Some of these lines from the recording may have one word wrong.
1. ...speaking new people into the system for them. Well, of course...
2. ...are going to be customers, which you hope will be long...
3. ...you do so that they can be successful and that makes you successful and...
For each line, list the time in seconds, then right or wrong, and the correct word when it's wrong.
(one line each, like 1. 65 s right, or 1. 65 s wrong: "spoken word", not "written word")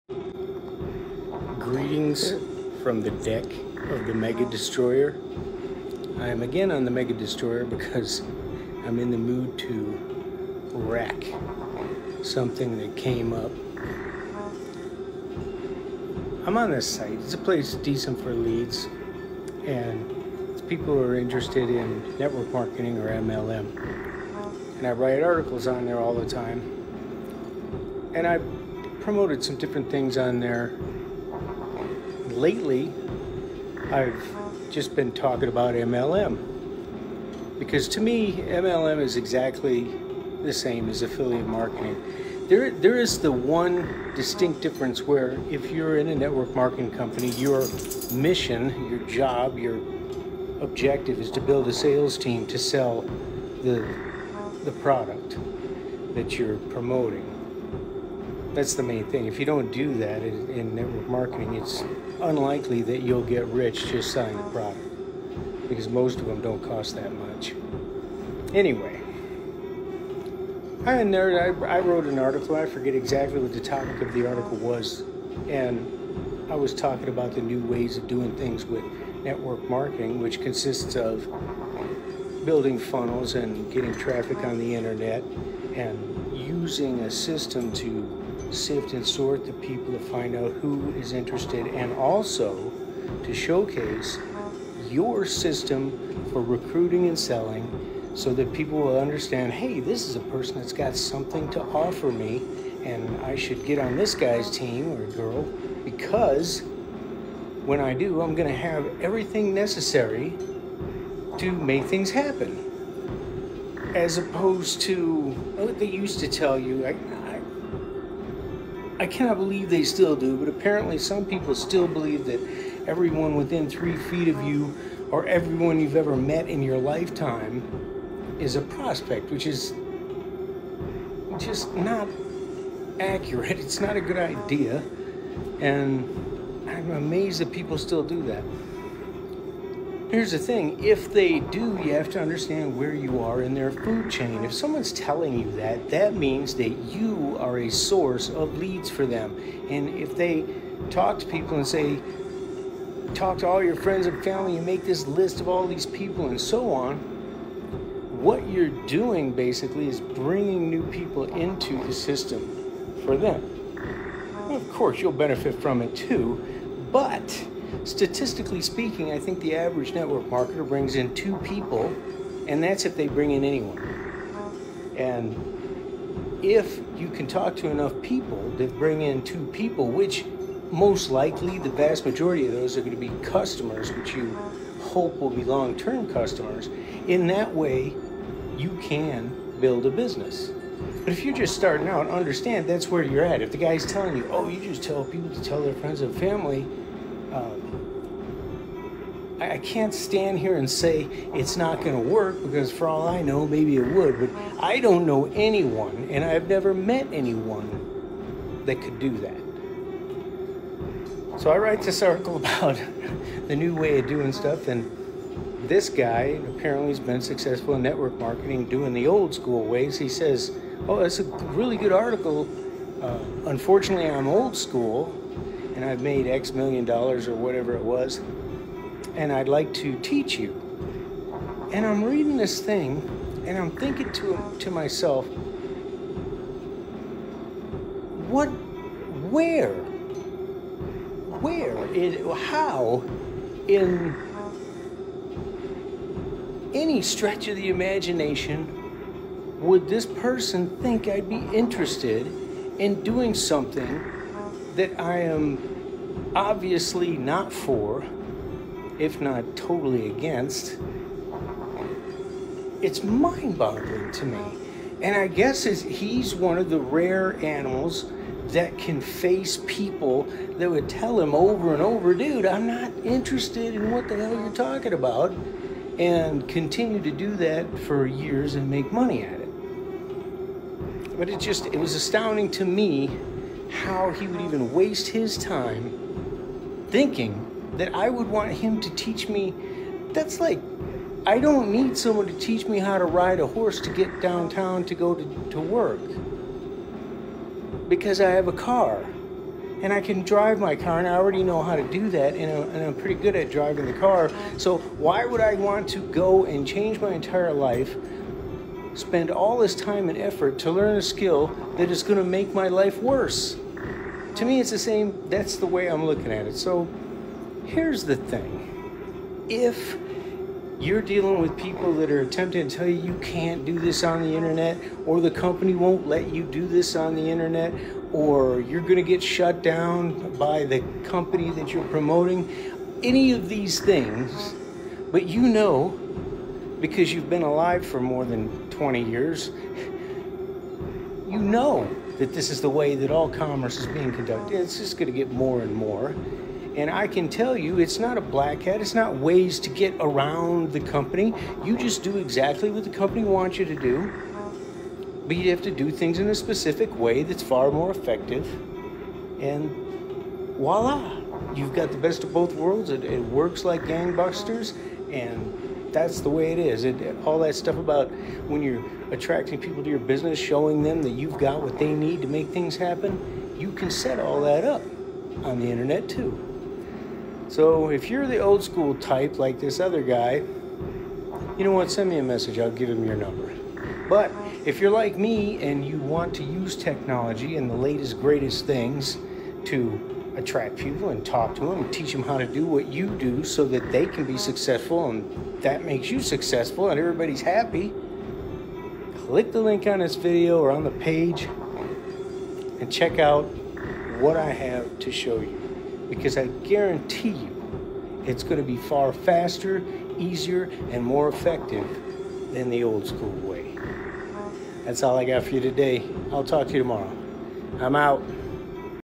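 1. 160 s wrong: "bringing", not "speaking"
2. 182 s right
3. 392 s right.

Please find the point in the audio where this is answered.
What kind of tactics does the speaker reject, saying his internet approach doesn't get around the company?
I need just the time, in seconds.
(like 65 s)
348 s.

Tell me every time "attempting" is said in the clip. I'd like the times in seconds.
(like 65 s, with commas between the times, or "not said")
322 s.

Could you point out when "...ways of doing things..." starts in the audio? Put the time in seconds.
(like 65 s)
77 s.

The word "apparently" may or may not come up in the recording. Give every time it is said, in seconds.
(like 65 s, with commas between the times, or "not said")
120 s, 216 s.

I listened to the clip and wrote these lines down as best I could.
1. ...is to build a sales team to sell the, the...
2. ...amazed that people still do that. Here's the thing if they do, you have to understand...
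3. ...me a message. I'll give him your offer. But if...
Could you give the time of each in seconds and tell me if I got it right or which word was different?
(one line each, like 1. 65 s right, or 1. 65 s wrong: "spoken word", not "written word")
1. 51 s right
2. 136 s right
3. 382 s wrong: "number", not "offer".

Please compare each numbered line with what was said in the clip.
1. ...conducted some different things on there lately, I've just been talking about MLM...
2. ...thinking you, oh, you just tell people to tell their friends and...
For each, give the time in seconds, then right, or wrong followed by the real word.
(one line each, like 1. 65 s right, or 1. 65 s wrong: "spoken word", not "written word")
1. 29 s wrong: "promoted", not "conducted"
2. 193 s wrong: "telling", not "thinking".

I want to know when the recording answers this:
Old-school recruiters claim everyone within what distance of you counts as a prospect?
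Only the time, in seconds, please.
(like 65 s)
123 s.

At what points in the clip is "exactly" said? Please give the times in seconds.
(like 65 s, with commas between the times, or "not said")
39 s, 72 s, 352 s.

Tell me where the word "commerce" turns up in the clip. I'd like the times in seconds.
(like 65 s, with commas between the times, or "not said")
343 s.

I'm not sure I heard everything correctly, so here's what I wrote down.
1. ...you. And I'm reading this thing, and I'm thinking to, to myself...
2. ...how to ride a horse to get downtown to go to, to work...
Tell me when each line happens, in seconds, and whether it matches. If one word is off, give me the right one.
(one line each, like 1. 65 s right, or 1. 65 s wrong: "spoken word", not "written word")
1. 230 s right
2. 292 s right.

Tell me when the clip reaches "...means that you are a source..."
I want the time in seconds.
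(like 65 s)
146 s.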